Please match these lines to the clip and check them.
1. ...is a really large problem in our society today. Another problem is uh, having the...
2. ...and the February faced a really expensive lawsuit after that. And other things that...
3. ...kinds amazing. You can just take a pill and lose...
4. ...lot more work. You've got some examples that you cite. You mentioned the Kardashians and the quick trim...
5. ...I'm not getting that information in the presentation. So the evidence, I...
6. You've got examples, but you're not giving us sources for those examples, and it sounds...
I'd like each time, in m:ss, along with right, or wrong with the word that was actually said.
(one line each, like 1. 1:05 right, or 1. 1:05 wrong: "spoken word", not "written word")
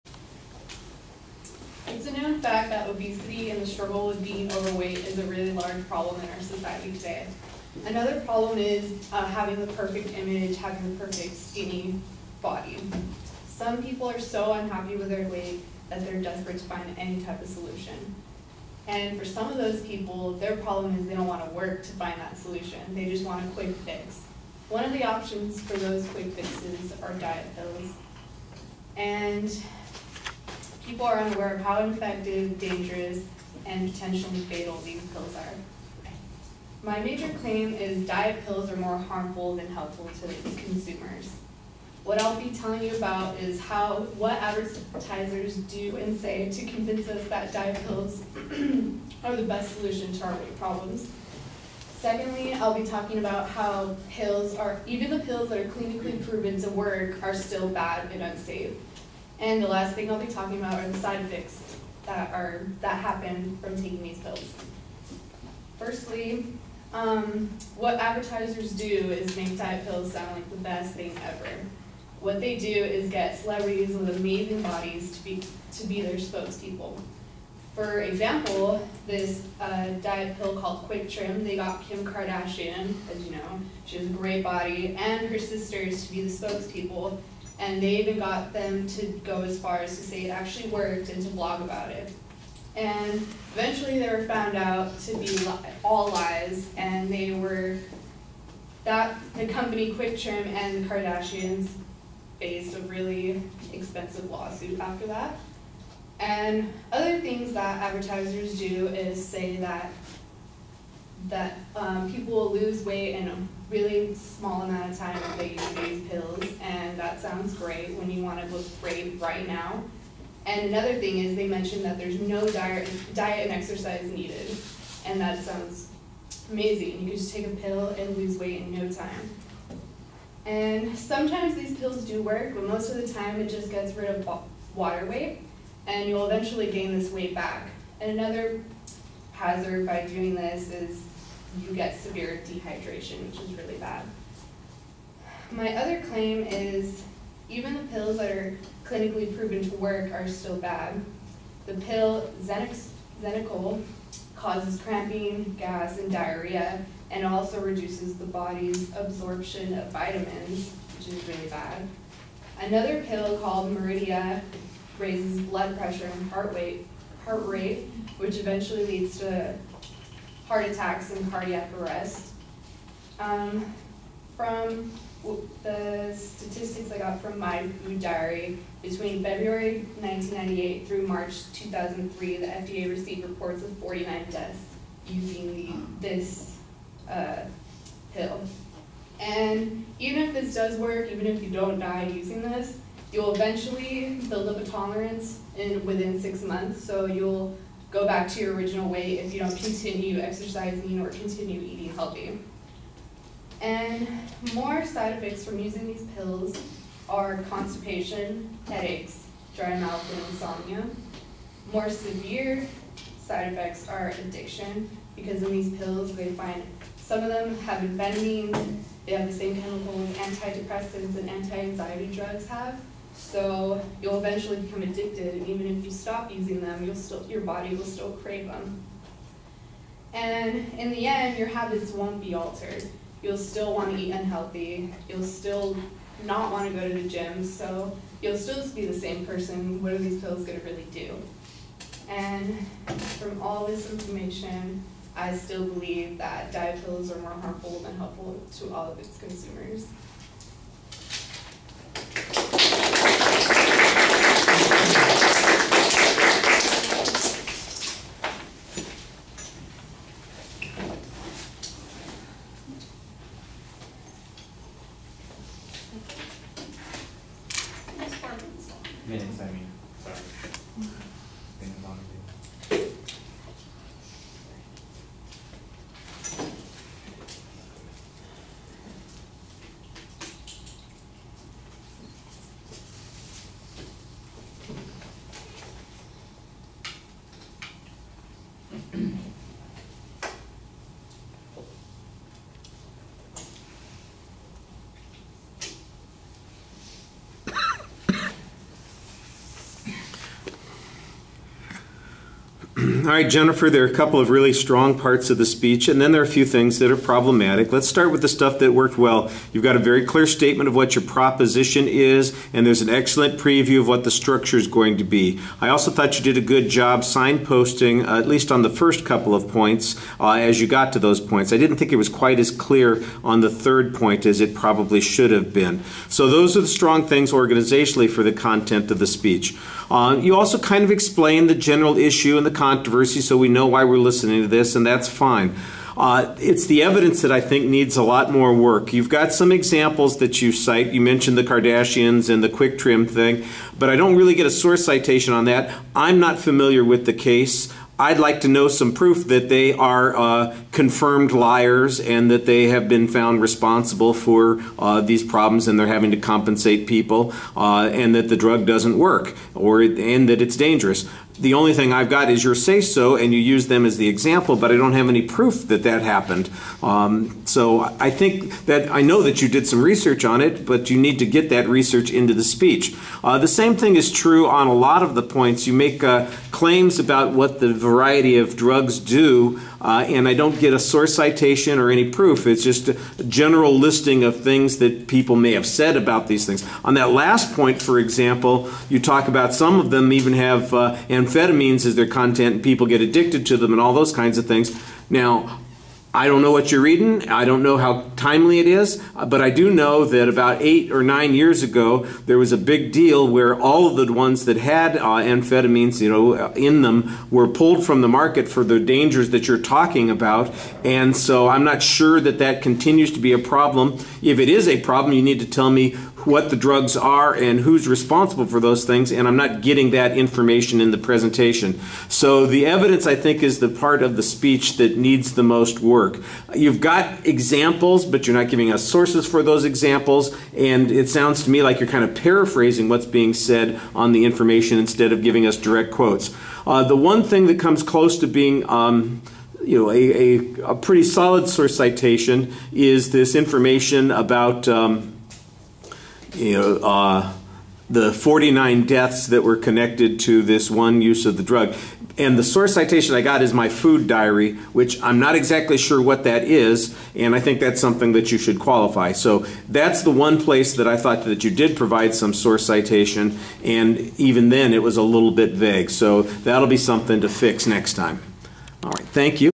1. 0:05 right
2. 1:40 wrong: "Kardashians", not "February"
3. 2:05 wrong: "sounds", not "kinds"
4. 5:38 right
5. 6:59 right
6. 7:06 right.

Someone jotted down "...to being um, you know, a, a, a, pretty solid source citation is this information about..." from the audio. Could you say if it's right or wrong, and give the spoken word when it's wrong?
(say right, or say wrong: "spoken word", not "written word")
right.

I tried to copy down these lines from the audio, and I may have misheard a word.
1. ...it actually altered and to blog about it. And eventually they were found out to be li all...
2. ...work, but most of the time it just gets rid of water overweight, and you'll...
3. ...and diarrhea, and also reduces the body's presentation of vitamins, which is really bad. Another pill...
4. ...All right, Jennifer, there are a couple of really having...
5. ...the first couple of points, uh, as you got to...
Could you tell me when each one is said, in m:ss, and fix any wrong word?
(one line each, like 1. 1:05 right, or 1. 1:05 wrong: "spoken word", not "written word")
1. 1:30 wrong: "worked", not "altered"
2. 2:12 wrong: "weight", not "overweight"
3. 2:35 wrong: "absorption", not "presentation"
4. 5:03 wrong: "strong", not "having"
5. 5:18 right.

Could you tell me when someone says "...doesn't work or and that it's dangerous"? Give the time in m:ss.
5:58.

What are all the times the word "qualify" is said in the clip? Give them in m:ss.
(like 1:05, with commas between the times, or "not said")
7:38.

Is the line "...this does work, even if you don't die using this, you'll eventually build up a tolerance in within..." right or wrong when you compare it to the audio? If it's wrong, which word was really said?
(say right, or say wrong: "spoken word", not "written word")
right.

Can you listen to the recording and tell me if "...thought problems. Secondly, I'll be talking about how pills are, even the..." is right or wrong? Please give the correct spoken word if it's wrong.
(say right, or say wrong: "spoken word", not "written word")
wrong: "weight", not "thought".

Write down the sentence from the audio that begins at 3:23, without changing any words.
And more side effects from using these pills are constipation, headaches, dry mouth, and insomnia.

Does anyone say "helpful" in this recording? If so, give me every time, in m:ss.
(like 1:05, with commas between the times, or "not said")
0:39, 4:07.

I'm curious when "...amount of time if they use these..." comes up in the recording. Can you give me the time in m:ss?
1:54.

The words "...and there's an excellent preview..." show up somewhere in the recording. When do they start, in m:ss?
5:12.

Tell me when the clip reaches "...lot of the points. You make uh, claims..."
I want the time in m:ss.
6:14.